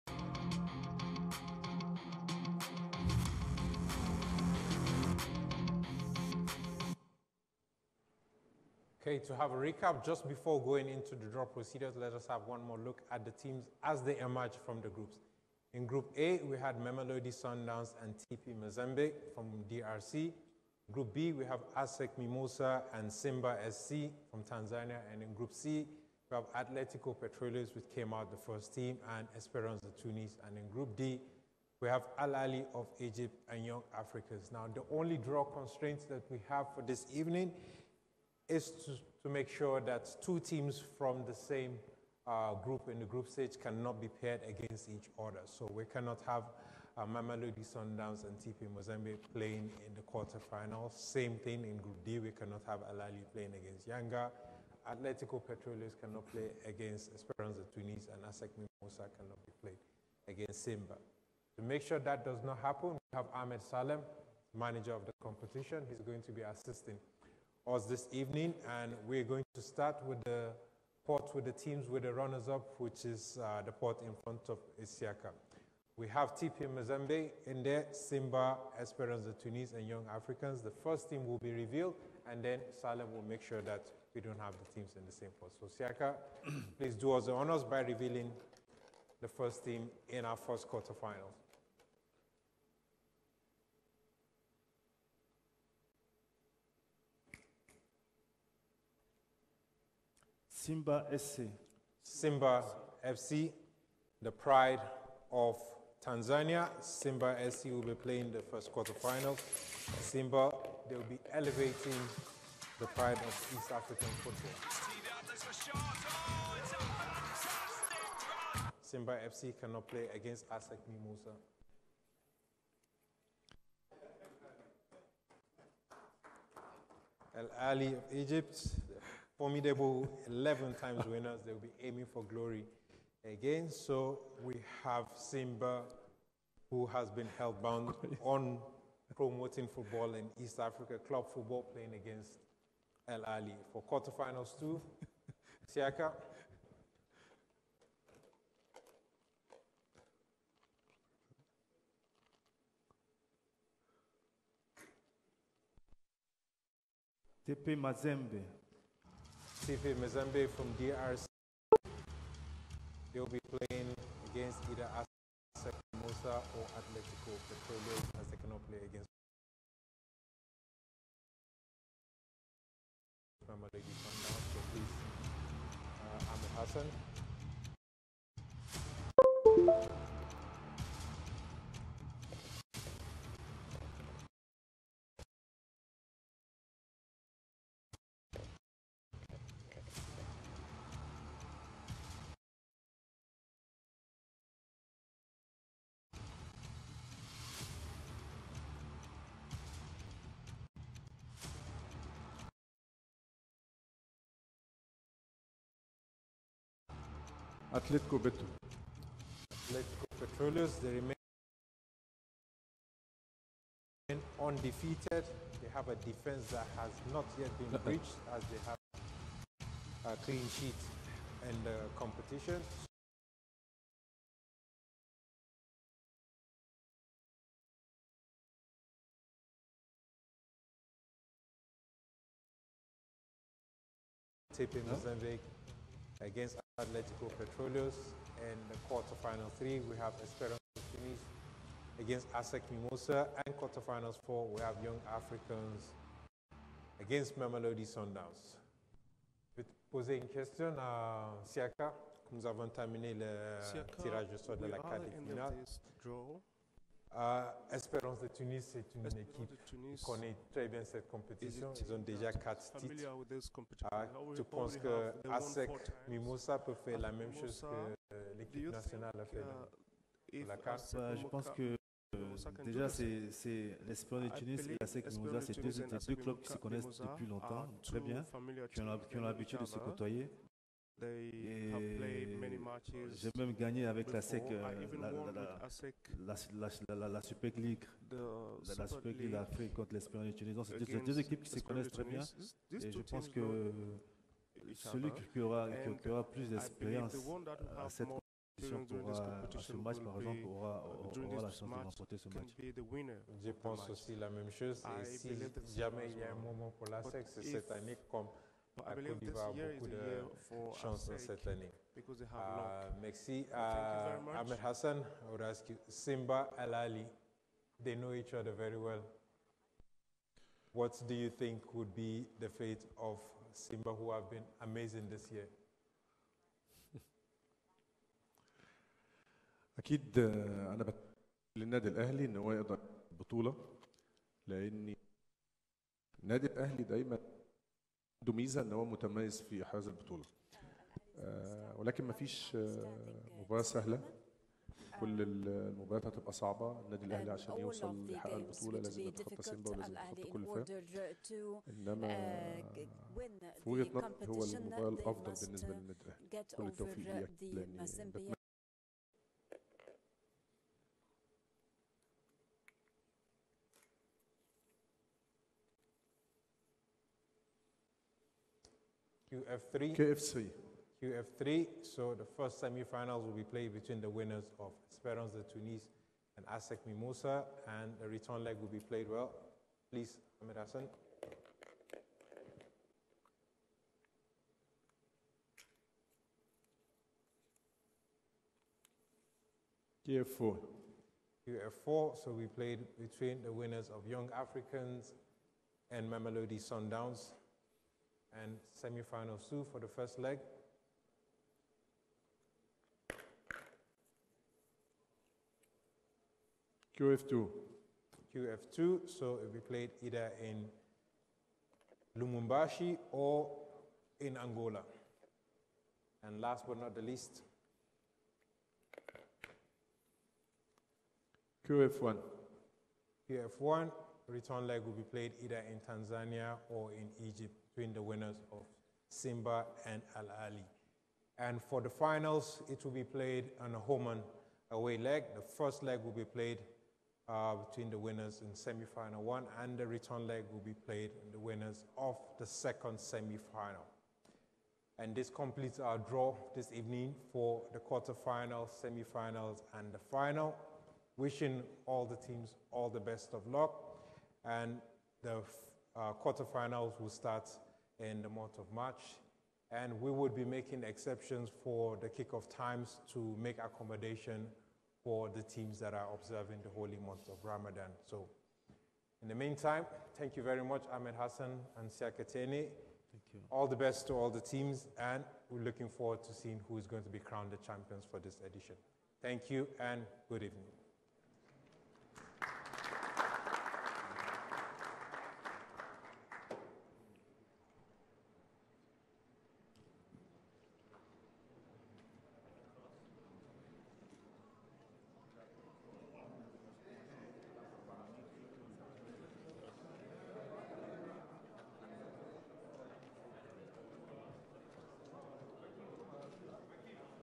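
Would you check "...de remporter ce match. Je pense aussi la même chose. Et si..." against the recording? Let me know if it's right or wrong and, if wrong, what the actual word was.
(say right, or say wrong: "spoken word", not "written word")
right.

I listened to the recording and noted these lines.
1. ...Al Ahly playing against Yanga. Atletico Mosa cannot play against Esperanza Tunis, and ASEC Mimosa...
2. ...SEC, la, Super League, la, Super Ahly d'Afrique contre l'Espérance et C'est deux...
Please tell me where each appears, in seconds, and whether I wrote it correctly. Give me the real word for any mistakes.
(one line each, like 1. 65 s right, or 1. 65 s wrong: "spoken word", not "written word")
1. 52 s wrong: "Petroleos", not "Mosa"
2. 284 s wrong: "League", not "Ahly".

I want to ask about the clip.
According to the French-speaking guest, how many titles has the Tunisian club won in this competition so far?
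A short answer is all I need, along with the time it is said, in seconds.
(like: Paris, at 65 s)
4, at 261 s.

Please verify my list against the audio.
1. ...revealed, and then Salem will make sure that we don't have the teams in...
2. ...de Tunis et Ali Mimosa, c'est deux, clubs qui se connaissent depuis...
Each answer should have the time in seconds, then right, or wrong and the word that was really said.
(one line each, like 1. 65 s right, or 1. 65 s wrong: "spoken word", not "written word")
1. 81 s right
2. 274 s wrong: "ASEC", not "Ali".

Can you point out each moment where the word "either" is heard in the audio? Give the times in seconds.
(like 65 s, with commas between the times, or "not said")
164 s, 410 s, 425 s.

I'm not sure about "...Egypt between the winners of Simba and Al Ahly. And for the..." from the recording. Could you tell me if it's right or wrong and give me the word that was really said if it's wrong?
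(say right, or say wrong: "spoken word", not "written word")
right.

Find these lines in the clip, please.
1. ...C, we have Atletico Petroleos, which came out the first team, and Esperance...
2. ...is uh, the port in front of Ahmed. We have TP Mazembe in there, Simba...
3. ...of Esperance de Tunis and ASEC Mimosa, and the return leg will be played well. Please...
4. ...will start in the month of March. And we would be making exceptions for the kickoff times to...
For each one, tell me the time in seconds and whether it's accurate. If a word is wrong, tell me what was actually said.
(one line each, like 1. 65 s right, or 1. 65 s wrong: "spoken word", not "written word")
1. 25 s right
2. 73 s wrong: "Isiaka", not "Ahmed"
3. 374 s right
4. 456 s right.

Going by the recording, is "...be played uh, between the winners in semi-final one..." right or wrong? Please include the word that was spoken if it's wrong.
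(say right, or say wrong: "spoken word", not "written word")
right.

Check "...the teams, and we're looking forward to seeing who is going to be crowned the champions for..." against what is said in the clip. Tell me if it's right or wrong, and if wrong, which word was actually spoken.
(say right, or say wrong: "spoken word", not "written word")
right.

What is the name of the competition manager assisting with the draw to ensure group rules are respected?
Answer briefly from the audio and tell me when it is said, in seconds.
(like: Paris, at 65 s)
Ahmed Salem, at 62 s.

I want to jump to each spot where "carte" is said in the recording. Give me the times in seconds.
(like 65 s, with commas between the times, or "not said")
254 s, 270 s.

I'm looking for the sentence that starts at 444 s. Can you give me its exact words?
And this completes our draw this evening for the quarterfinals, semi-finals, and the final.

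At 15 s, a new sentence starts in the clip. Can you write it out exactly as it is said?
In Group A, we had Mamelodi Sundowns and TP Mazembe from DRC.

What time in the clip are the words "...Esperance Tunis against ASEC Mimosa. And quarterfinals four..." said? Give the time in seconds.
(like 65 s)
240 s.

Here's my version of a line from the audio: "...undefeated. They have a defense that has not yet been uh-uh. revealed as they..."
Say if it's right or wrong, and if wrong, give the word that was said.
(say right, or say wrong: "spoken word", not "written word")
wrong: "breached", not "revealed".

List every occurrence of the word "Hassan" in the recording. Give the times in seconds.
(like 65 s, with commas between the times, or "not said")
176 s, 314 s, 380 s, 471 s.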